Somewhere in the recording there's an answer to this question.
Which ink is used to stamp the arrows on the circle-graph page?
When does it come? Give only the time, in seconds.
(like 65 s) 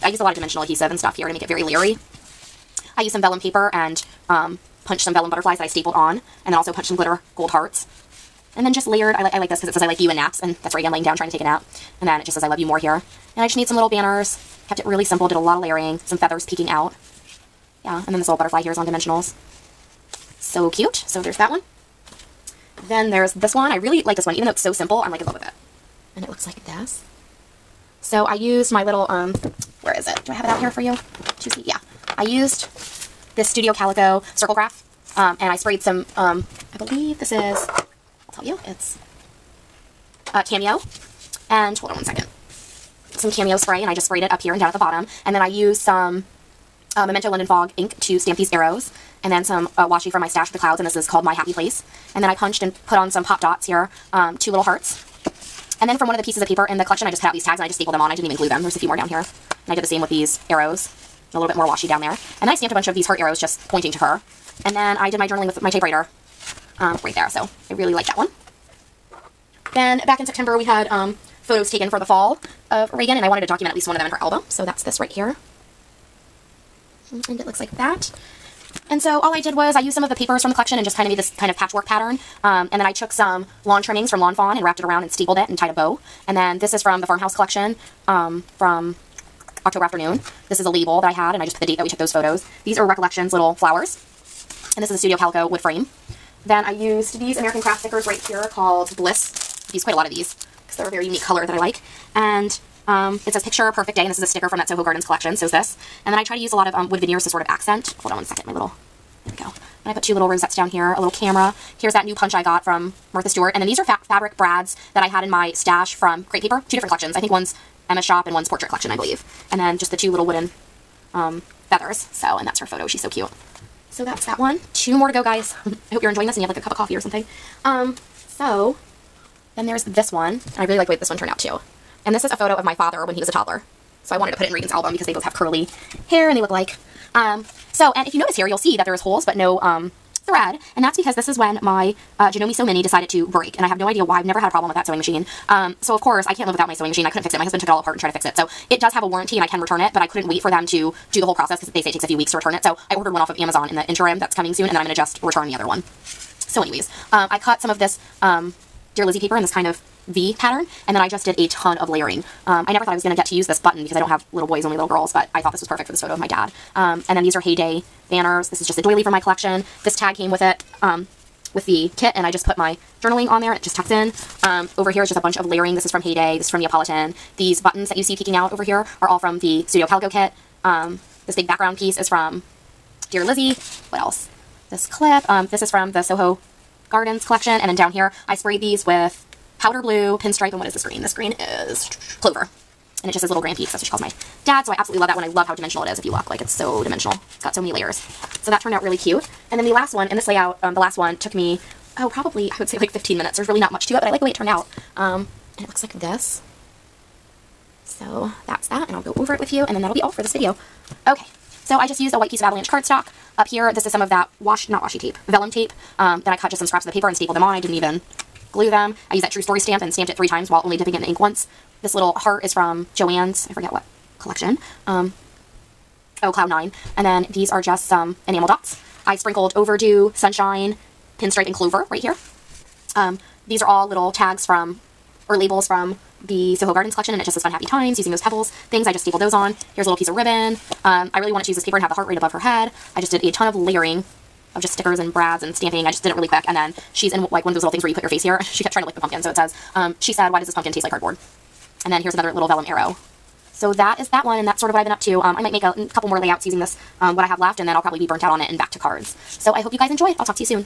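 47 s.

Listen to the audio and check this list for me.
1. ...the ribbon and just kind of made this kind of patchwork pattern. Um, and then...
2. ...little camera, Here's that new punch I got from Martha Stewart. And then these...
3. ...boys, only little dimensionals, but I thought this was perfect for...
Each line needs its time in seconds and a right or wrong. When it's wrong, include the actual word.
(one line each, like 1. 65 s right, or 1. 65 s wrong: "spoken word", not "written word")
1. 80 s wrong: "collection", not "ribbon"
2. 111 s right
3. 164 s wrong: "girls", not "dimensionals".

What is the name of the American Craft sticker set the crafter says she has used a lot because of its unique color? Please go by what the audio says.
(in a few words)
Bliss.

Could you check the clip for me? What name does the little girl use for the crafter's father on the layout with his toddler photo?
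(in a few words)
Little Grampy.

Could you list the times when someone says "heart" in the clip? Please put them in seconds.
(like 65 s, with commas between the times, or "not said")
7 s, 54 s, 63 s, 222 s, 241 s.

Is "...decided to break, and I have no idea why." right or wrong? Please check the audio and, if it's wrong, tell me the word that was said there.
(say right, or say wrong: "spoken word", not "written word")
right.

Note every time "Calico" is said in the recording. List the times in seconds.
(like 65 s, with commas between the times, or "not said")
33 s, 95 s, 179 s.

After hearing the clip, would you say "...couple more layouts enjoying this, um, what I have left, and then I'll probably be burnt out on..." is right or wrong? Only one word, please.
wrong.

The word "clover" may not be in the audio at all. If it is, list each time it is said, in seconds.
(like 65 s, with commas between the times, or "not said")
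192 s, 231 s.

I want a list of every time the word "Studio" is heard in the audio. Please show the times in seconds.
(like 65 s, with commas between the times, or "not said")
33 s, 94 s, 179 s.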